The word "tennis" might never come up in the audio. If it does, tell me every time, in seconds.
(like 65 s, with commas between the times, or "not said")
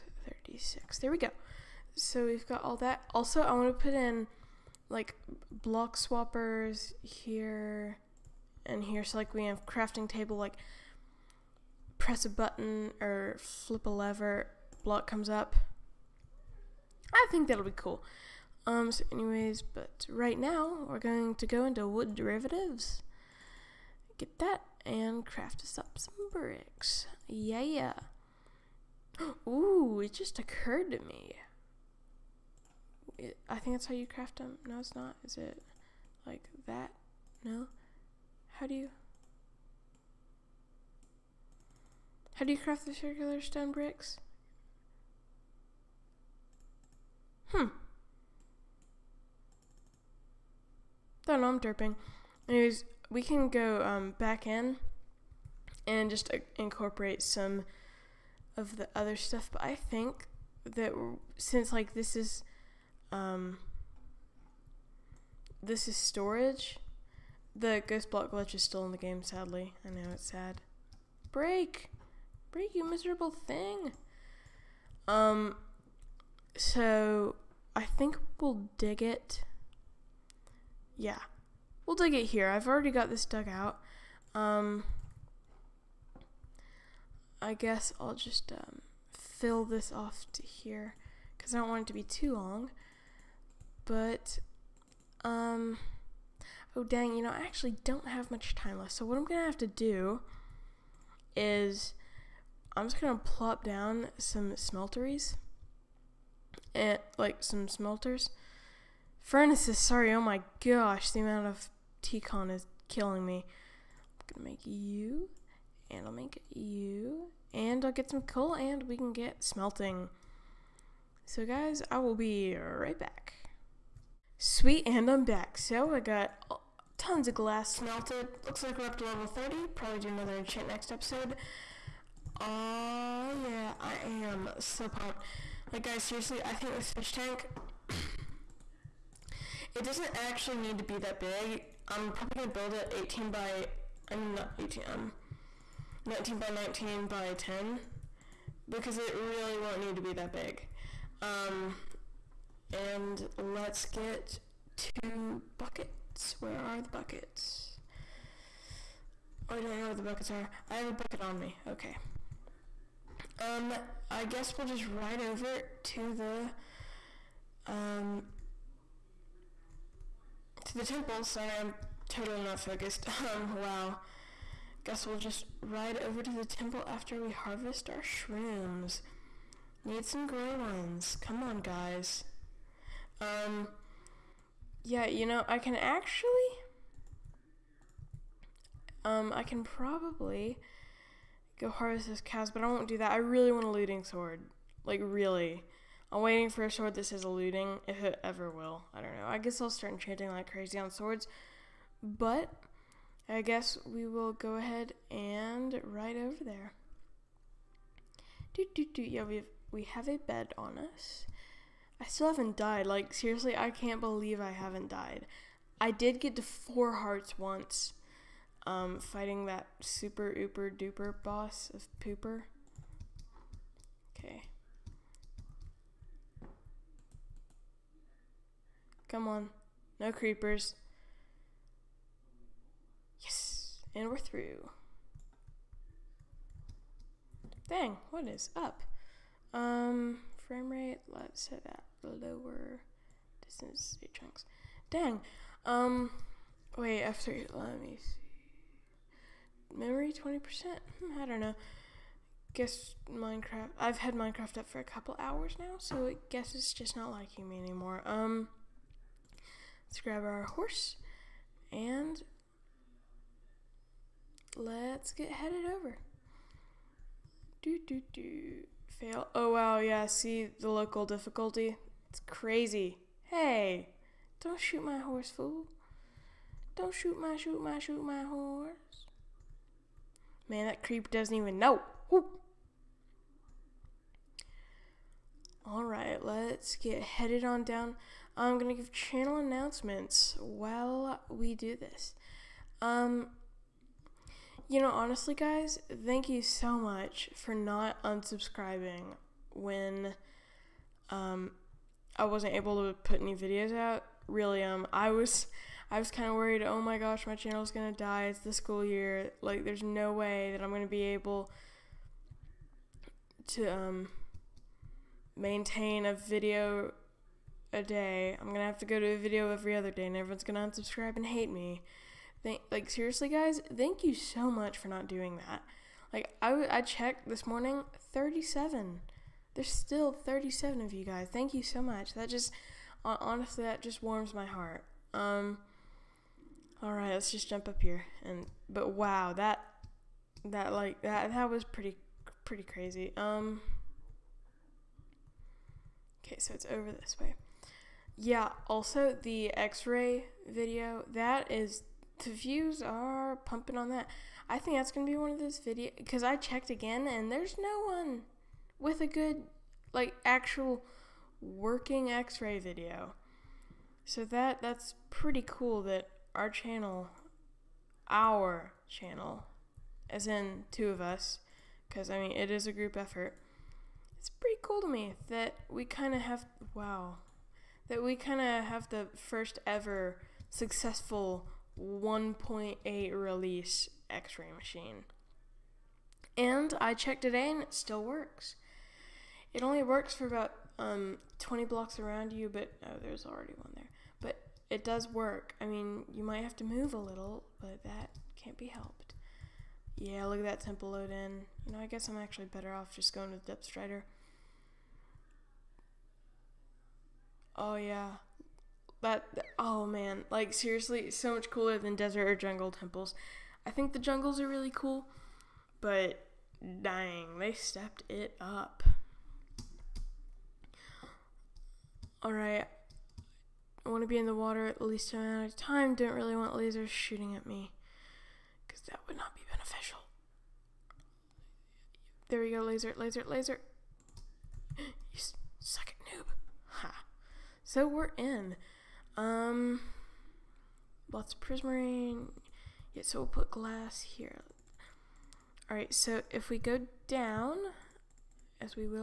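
not said.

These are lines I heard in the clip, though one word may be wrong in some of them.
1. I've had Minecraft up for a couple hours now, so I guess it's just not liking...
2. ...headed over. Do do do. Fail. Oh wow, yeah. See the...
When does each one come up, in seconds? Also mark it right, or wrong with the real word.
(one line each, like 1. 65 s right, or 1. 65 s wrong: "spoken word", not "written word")
1. 253 s right
2. 265 s right.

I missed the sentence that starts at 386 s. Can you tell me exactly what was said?
And I checked today and it still works.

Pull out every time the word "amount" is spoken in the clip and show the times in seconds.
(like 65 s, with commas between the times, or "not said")
111 s, 425 s.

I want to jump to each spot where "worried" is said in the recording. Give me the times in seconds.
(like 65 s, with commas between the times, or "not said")
306 s.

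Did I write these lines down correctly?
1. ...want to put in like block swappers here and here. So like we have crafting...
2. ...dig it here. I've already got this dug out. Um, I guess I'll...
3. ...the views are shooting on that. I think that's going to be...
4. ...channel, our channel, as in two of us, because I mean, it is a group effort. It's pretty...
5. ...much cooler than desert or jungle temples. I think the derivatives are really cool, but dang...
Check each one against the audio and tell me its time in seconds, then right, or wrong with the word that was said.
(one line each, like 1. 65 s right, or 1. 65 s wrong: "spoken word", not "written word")
1. 3 s right
2. 81 s right
3. 352 s wrong: "pumping", not "shooting"
4. 366 s right
5. 411 s wrong: "jungles", not "derivatives".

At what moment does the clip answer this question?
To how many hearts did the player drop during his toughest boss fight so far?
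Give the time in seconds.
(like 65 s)
216 s.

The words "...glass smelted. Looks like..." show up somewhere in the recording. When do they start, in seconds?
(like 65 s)
127 s.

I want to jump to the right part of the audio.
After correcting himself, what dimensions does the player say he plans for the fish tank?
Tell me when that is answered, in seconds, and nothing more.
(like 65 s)
146 s.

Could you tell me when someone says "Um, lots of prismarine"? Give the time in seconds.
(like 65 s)
439 s.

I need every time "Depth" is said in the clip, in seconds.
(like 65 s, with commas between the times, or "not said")
403 s.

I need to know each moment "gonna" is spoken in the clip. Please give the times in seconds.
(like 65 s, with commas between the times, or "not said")
114 s, 288 s.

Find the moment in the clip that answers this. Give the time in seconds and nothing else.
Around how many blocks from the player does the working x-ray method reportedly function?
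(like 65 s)
391 s.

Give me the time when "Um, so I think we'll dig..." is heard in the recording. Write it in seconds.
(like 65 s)
75 s.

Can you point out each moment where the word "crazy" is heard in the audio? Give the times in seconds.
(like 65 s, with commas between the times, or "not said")
200 s, 272 s, 342 s.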